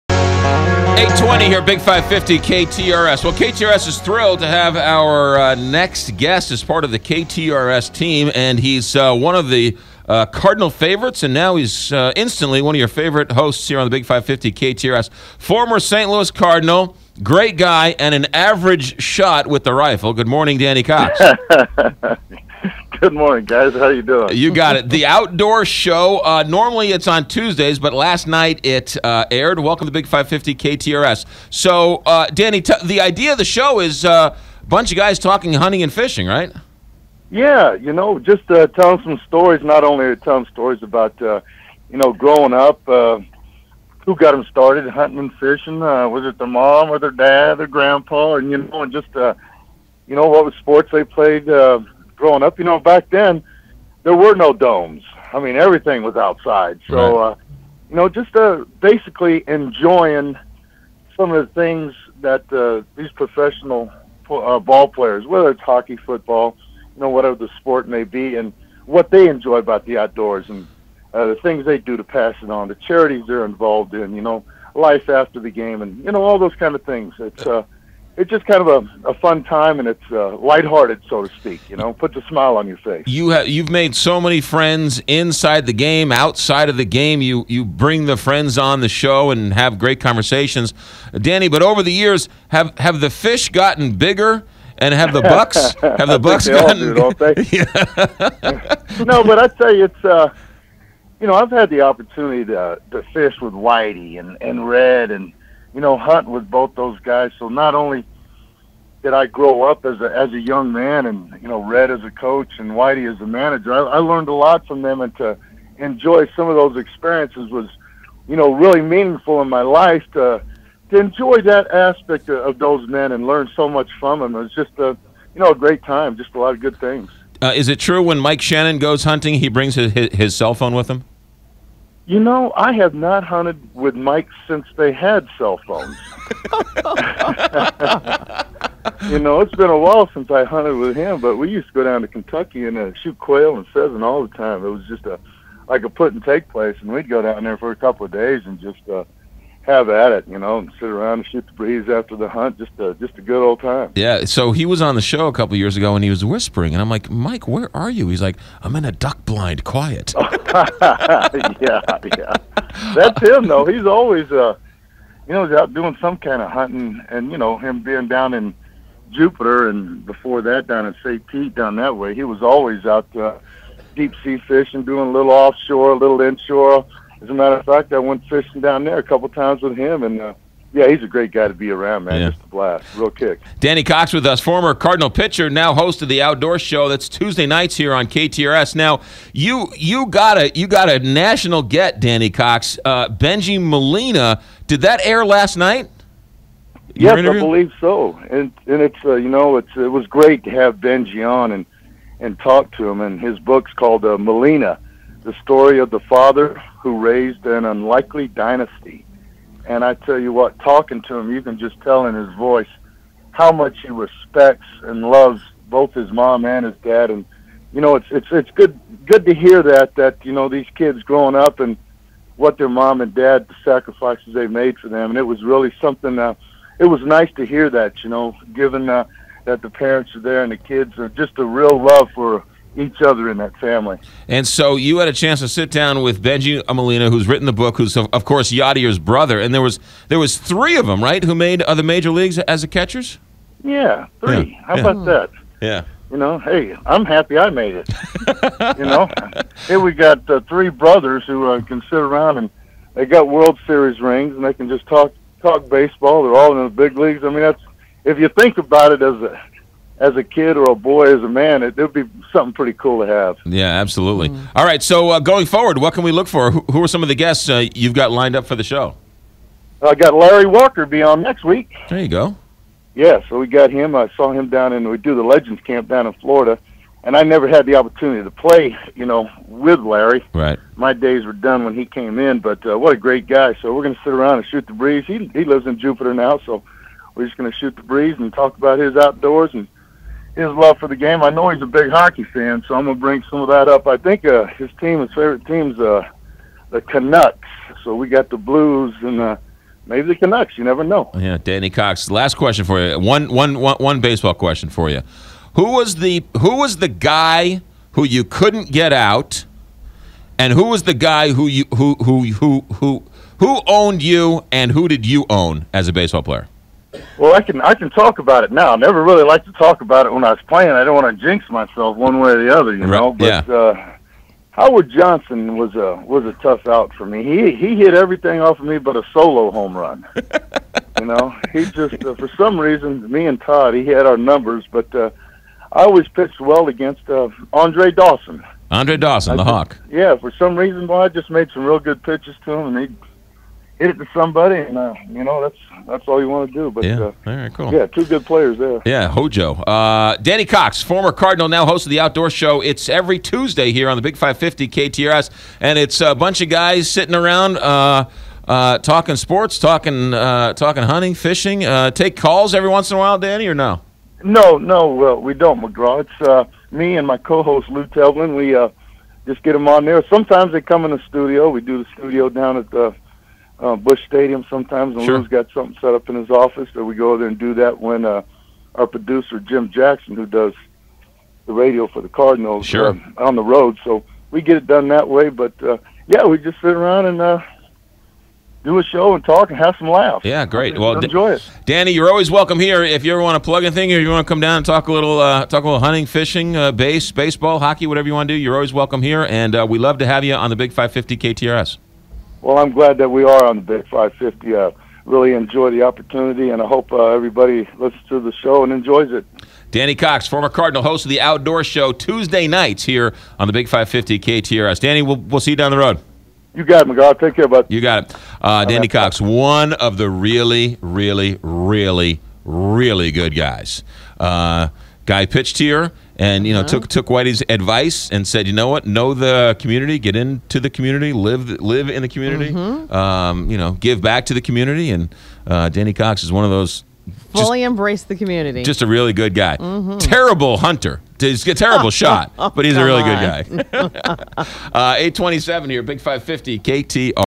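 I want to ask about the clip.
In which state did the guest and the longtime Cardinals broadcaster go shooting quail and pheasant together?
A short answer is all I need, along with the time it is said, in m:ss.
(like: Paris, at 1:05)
Kentucky, at 2:22.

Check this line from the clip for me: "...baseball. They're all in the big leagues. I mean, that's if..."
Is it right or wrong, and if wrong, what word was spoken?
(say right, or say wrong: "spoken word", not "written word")
right.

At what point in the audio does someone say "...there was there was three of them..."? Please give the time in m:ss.
3:59.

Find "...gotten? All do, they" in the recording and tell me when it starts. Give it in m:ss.
1:36.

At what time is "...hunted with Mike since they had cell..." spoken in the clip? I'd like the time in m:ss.
2:13.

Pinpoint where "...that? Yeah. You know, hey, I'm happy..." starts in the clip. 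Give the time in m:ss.
4:05.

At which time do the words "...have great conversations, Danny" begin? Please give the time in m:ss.
1:29.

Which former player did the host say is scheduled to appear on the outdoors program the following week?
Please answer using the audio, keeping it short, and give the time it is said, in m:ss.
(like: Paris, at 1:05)
Larry Walker, at 4:30.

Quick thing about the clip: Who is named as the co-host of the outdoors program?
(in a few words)
Lou Telvin.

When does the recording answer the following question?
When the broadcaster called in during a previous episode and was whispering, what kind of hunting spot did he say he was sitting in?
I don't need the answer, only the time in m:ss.
2:38.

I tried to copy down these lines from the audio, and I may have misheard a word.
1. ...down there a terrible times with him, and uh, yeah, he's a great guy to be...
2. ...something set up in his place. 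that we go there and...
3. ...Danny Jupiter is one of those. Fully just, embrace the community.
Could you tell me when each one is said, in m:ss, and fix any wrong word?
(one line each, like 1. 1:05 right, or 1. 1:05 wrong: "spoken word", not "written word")
1. 2:58 wrong: "couple", not "terrible"
2. 6:15 wrong: "office", not "place"
3. 7:15 wrong: "Cox", not "Jupiter".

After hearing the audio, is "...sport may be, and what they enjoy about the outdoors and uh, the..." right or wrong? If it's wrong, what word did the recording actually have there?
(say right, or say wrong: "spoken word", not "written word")
right.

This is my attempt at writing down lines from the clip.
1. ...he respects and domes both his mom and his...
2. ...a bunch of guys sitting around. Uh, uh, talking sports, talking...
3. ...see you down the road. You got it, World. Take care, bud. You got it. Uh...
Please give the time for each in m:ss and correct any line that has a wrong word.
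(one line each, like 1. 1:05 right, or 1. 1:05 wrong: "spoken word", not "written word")
1. 3:33 wrong: "loves", not "domes"
2. 5:55 right
3. 6:55 wrong: "McGraw", not "World".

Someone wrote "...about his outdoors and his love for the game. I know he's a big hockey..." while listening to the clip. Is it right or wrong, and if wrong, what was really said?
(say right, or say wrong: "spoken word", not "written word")
right.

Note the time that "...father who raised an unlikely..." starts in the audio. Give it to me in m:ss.
3:25.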